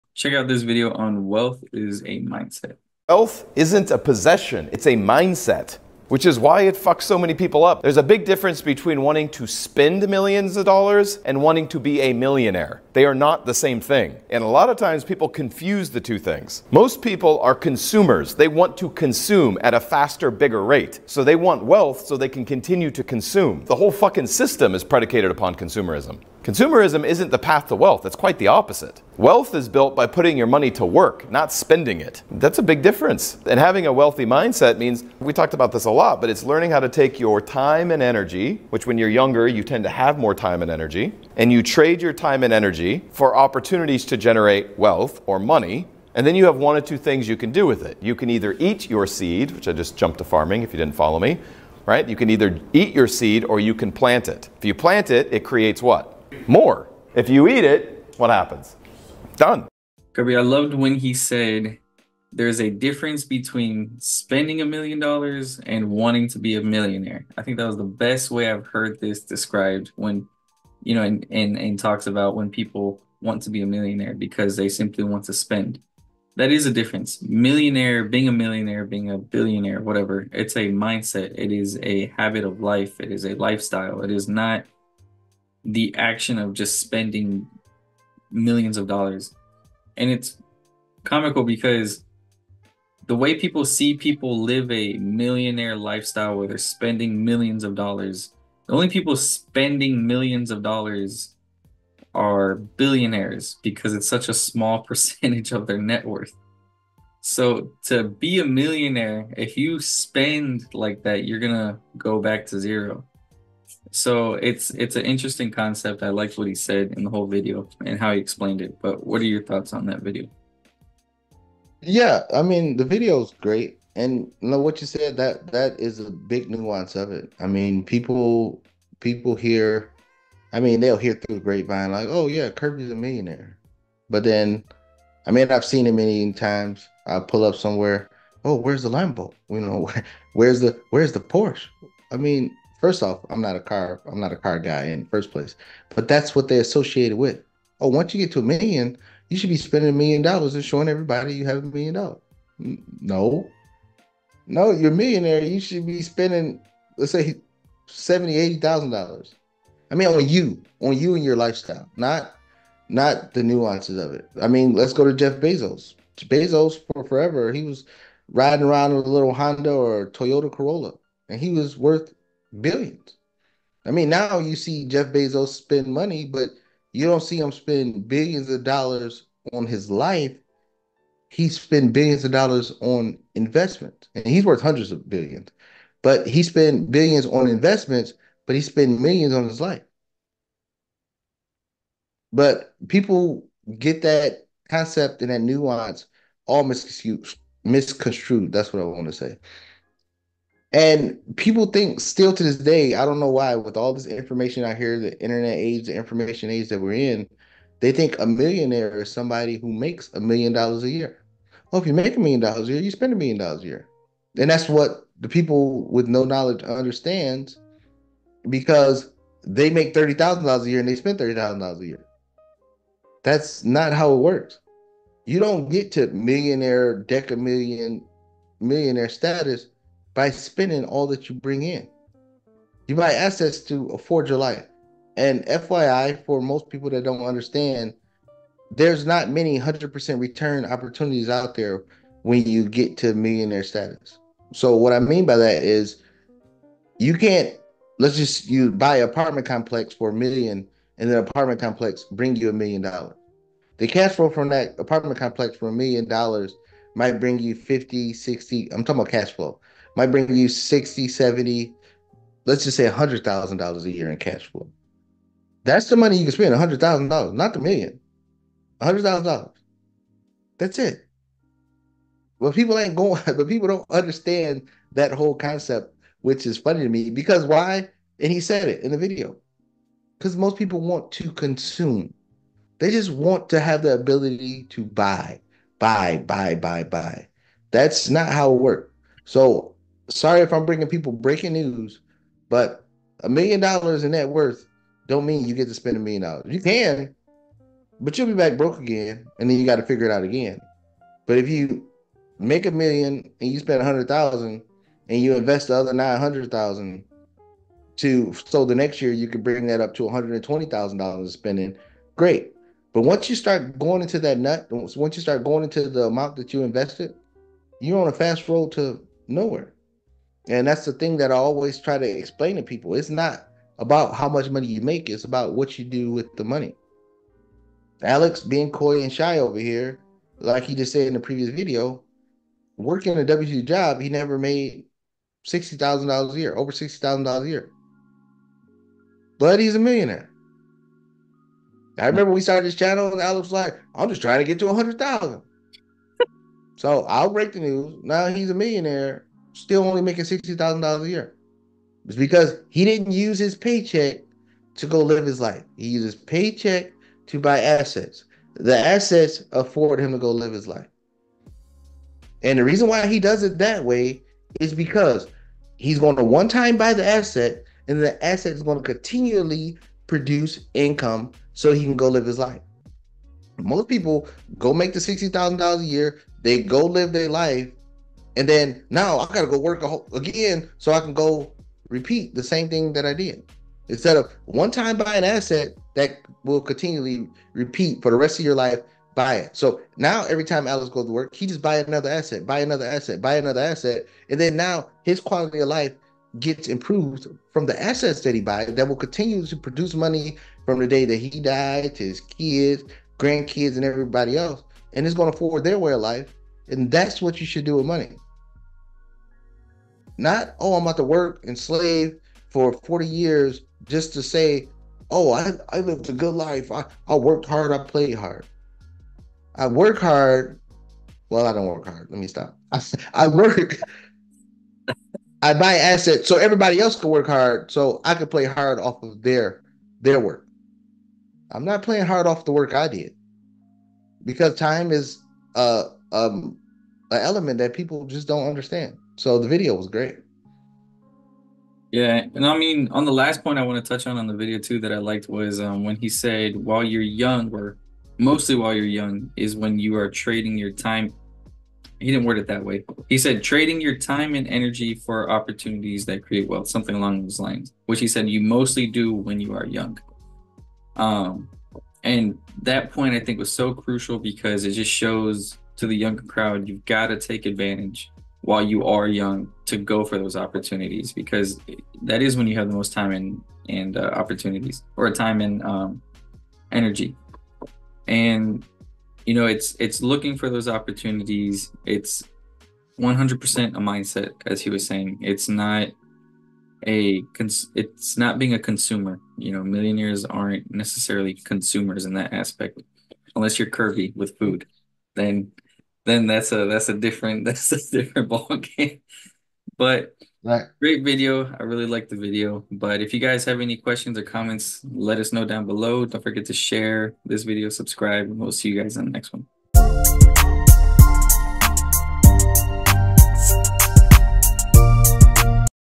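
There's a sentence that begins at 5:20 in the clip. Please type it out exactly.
And that's the thing that I always try to explain to people.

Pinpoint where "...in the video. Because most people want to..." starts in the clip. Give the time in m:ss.
4:38.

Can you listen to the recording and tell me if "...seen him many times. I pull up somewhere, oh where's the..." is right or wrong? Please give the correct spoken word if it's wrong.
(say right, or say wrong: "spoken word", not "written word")
right.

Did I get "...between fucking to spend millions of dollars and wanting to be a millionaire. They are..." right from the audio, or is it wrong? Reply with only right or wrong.
wrong.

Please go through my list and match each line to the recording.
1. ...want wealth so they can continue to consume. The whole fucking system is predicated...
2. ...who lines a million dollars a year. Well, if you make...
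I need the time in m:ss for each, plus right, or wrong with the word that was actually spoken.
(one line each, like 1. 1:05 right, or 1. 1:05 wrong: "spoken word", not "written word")
1. 0:21 right
2. 3:29 wrong: "makes", not "lines".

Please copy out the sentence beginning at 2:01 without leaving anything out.
Yeah, I mean the video is great, and you know, what you said that that is a big nuance of it.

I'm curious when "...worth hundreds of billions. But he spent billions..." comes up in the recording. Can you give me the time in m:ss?
3:04.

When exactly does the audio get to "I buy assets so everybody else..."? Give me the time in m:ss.
7:05.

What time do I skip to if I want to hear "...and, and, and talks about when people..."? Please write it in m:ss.
1:11.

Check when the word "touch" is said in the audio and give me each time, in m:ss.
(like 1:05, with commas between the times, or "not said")
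7:23.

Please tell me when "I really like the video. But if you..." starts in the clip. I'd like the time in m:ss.
8:21.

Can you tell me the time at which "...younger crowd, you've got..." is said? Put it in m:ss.
7:45.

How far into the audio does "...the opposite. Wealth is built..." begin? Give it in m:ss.
0:28.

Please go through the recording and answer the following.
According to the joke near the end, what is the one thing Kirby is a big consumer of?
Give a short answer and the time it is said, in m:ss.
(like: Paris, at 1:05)
Food, at 8:14.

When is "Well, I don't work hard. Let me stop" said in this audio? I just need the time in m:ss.
7:01.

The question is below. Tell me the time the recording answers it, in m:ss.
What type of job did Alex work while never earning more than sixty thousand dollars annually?
5:33.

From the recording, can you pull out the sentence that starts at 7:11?
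I'm not playing hard off the work I did because time is uh um an element that people just don't understand.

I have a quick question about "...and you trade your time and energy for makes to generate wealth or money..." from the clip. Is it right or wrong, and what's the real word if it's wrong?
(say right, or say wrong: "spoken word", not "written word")
wrong: "opportunities", not "makes".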